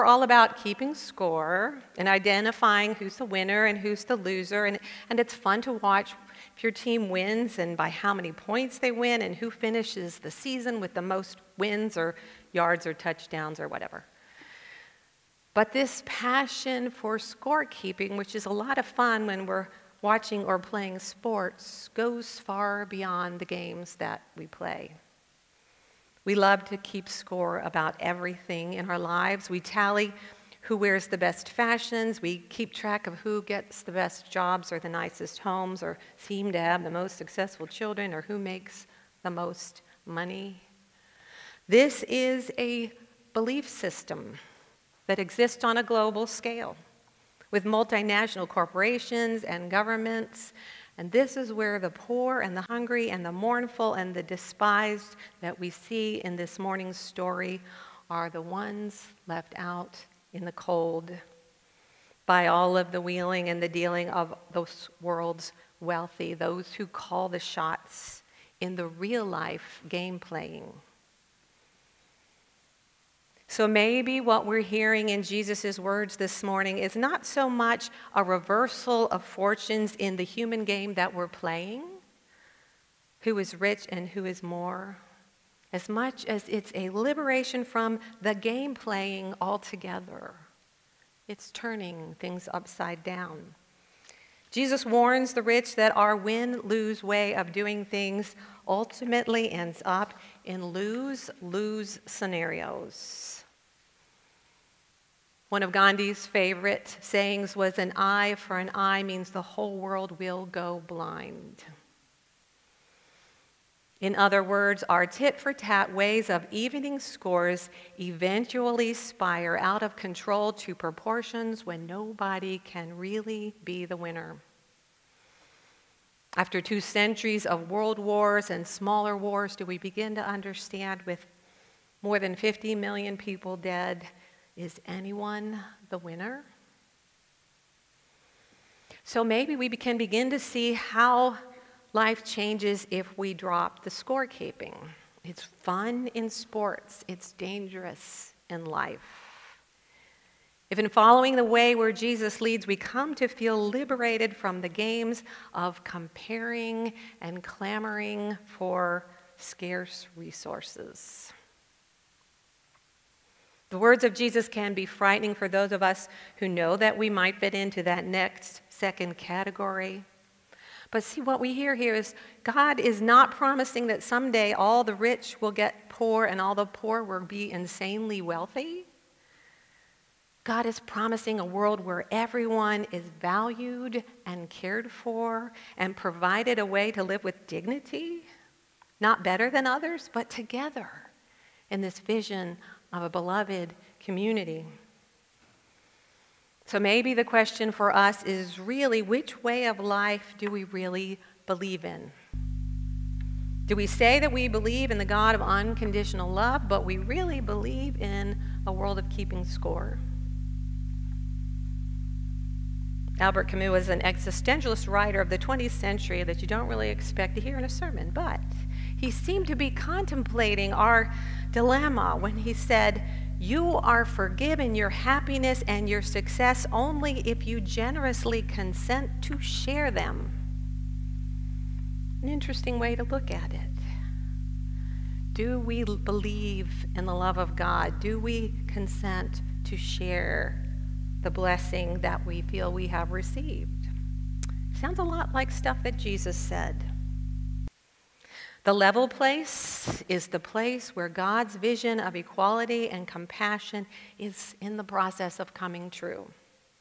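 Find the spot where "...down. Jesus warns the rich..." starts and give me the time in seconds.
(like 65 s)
93 s.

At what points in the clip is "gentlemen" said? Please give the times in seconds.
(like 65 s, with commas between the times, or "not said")
not said.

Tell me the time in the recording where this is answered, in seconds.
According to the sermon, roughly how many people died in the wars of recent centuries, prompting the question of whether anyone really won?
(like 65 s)
132 s.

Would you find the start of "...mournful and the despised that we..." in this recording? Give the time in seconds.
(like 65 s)
53 s.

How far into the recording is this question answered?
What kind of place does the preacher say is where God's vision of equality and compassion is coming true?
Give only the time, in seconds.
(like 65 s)
248 s.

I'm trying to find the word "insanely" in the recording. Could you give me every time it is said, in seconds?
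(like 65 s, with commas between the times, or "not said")
177 s.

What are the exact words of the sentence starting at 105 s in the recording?
One of Gandhi's favorite sayings was an eye for an eye means the whole world will go blind.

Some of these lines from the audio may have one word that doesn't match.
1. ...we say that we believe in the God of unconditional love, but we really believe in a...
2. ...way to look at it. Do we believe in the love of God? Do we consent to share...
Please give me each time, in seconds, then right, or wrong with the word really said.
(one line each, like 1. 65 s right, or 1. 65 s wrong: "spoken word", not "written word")
1. 203 s right
2. 232 s right.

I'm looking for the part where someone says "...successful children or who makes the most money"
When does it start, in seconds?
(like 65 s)
37 s.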